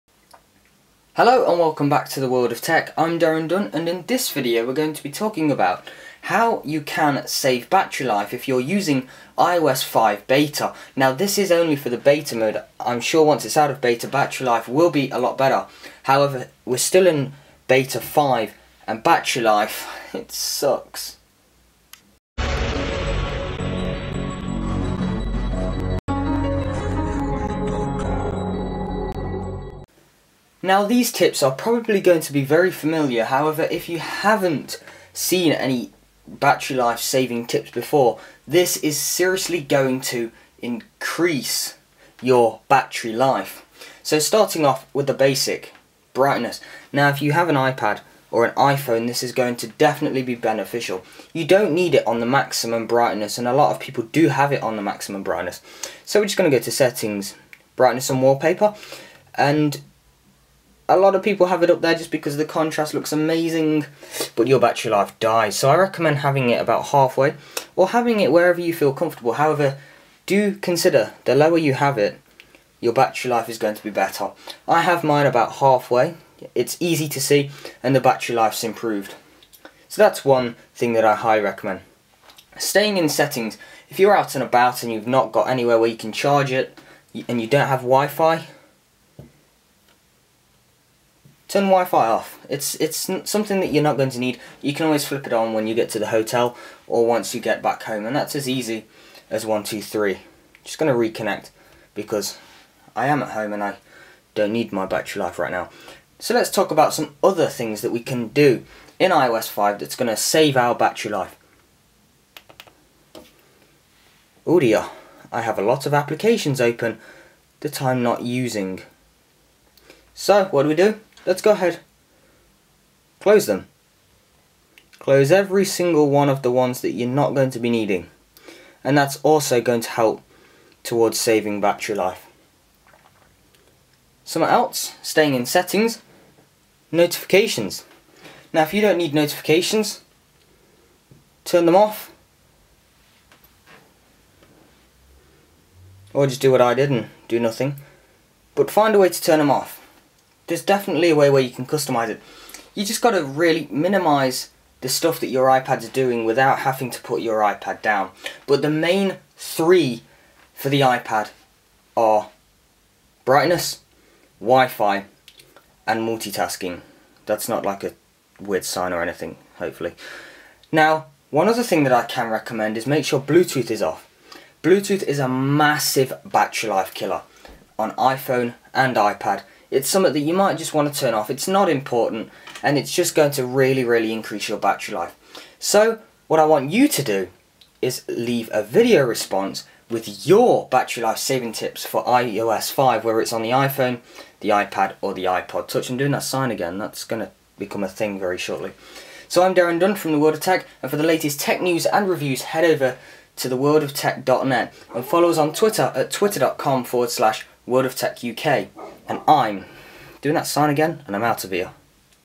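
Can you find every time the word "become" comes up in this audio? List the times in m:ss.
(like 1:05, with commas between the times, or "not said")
3:17.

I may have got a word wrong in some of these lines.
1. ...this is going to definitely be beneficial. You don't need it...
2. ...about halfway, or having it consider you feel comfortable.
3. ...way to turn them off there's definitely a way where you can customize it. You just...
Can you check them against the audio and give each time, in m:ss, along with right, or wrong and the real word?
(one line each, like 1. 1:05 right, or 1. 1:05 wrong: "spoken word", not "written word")
1. 0:49 right
2. 1:06 wrong: "wherever", not "consider"
3. 2:28 right.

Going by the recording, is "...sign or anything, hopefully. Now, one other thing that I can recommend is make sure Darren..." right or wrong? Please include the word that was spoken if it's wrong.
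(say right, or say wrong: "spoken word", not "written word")
wrong: "Bluetooth", not "Darren".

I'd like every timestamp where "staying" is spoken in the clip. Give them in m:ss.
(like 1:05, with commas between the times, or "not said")
1:22, 2:15.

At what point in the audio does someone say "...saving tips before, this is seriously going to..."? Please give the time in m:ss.
0:36.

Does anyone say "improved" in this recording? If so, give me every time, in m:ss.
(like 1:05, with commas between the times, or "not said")
1:18.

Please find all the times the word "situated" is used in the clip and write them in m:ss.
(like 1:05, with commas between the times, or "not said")
not said.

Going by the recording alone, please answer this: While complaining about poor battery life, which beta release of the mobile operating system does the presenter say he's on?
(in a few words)
5.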